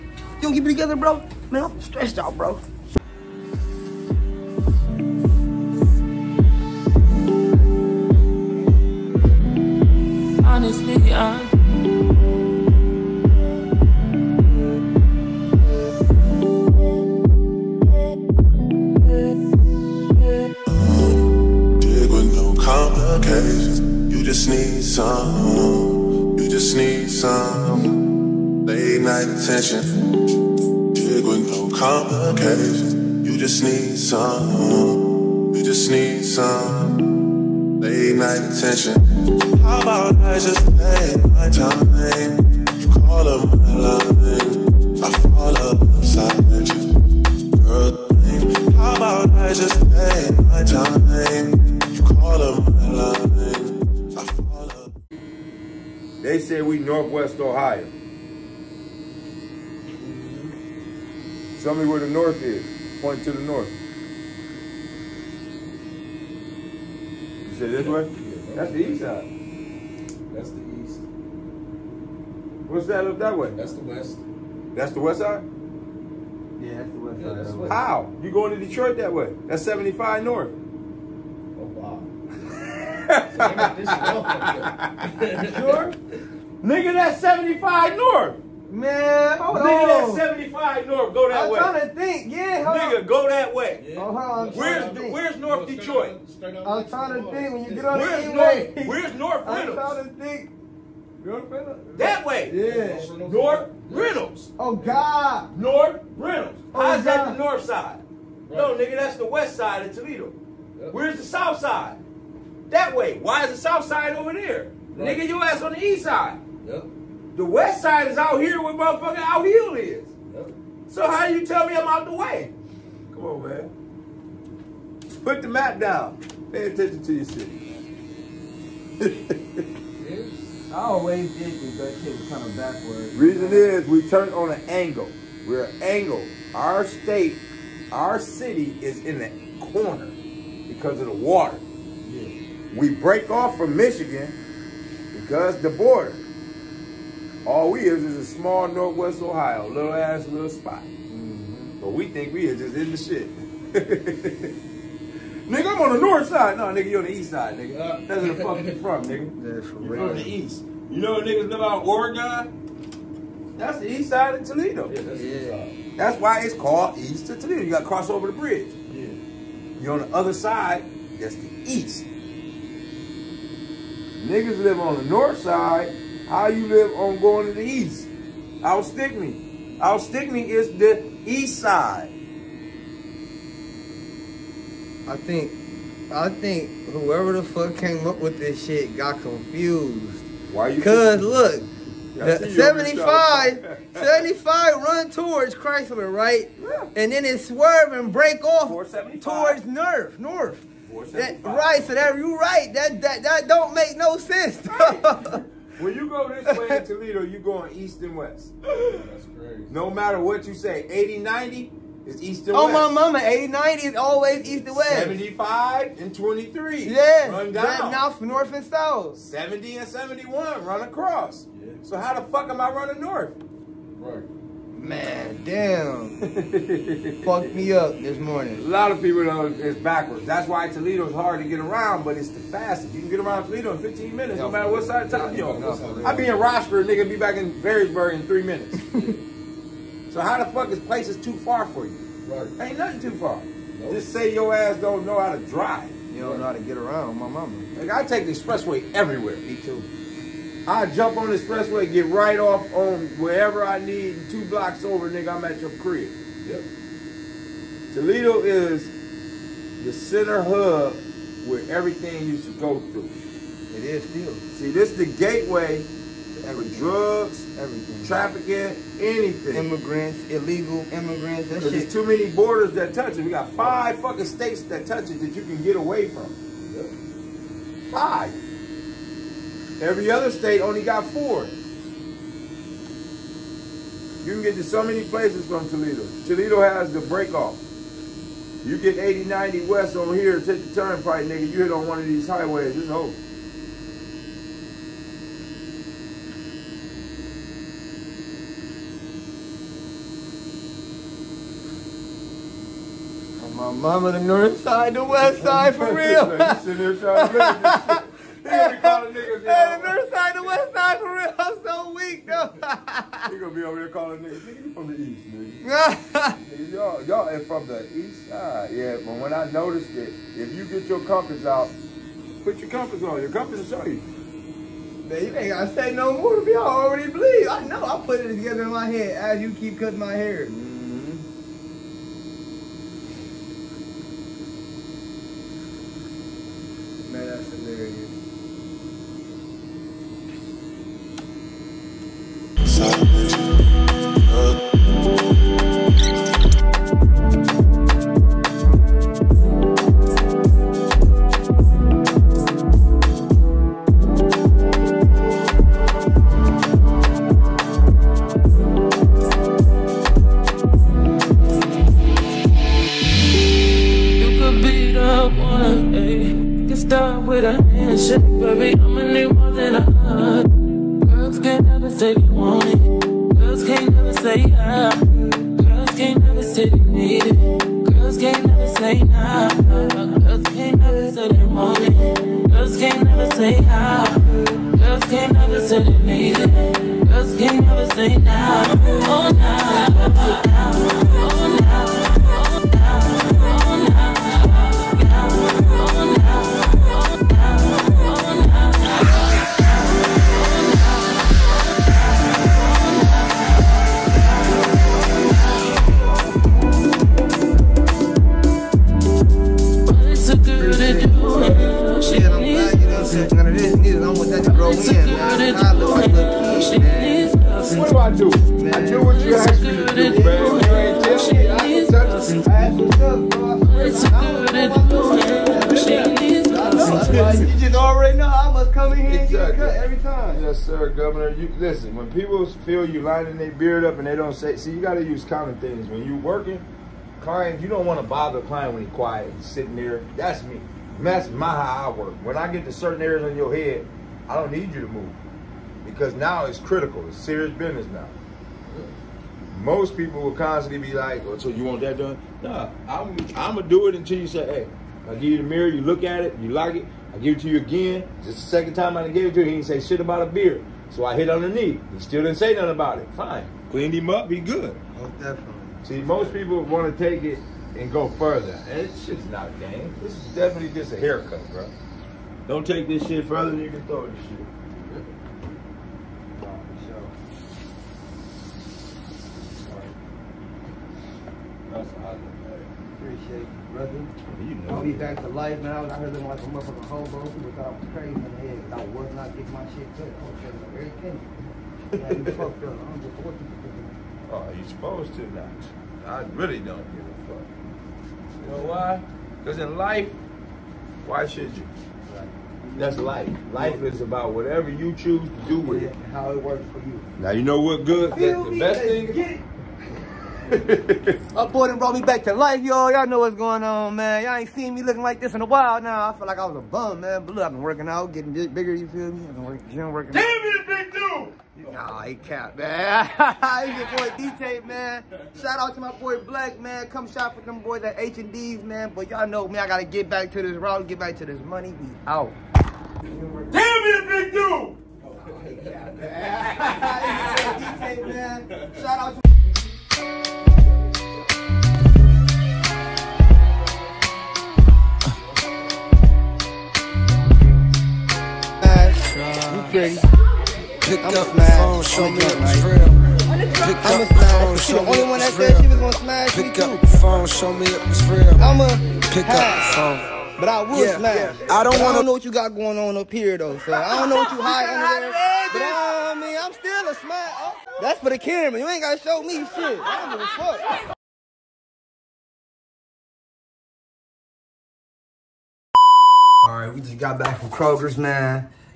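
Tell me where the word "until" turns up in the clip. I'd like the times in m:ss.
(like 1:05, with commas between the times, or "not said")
7:33.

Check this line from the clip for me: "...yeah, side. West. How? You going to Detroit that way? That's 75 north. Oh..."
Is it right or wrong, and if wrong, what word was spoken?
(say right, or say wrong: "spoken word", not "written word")
right.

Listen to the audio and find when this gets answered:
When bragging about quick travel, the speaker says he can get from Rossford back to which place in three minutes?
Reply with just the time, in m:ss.
3:57.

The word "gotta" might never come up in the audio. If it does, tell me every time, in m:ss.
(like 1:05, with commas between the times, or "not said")
5:25, 8:49, 9:28.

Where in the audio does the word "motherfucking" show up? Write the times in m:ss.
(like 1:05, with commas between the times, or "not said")
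1:58, 8:06.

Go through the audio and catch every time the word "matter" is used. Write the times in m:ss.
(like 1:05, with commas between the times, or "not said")
3:29, 3:54.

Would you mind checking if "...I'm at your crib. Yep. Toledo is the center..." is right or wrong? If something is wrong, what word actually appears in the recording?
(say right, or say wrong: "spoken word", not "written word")
right.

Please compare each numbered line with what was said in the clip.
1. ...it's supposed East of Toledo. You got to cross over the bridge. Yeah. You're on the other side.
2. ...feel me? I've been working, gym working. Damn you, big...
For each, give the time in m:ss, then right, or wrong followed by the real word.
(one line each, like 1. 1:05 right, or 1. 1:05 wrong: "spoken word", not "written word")
1. 2:46 wrong: "called", not "supposed"
2. 8:38 right.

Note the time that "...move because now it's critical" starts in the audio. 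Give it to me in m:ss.
7:24.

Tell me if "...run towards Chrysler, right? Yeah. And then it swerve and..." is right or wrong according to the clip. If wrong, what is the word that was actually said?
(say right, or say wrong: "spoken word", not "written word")
right.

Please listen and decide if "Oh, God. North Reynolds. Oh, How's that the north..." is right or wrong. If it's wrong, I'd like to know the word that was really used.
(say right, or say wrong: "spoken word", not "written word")
right.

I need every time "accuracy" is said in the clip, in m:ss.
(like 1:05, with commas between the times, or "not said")
not said.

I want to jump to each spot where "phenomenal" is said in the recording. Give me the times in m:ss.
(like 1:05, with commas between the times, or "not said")
not said.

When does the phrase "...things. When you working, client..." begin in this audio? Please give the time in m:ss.
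7:15.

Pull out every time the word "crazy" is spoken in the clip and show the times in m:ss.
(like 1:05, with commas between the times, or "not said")
3:29, 8:07.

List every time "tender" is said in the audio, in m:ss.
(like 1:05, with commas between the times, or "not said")
not said.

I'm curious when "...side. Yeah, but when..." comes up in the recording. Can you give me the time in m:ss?
5:18.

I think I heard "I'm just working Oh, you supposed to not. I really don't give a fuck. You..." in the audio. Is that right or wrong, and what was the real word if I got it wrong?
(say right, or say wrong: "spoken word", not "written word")
right.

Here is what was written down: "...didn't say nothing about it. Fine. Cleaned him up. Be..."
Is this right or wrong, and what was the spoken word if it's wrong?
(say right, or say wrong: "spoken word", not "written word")
right.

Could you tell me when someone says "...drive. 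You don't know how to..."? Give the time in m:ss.
4:05.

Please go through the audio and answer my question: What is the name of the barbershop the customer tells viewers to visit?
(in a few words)
H&D's.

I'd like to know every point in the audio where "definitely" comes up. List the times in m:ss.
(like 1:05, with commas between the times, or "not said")
7:45, 7:50.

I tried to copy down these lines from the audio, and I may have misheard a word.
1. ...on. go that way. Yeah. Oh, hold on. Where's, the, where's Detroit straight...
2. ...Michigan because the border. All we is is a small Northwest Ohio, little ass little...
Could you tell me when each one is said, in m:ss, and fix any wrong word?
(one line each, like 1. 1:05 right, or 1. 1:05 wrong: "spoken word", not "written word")
1. 1:33 wrong: "North", not "Detroit"
2. 2:23 right.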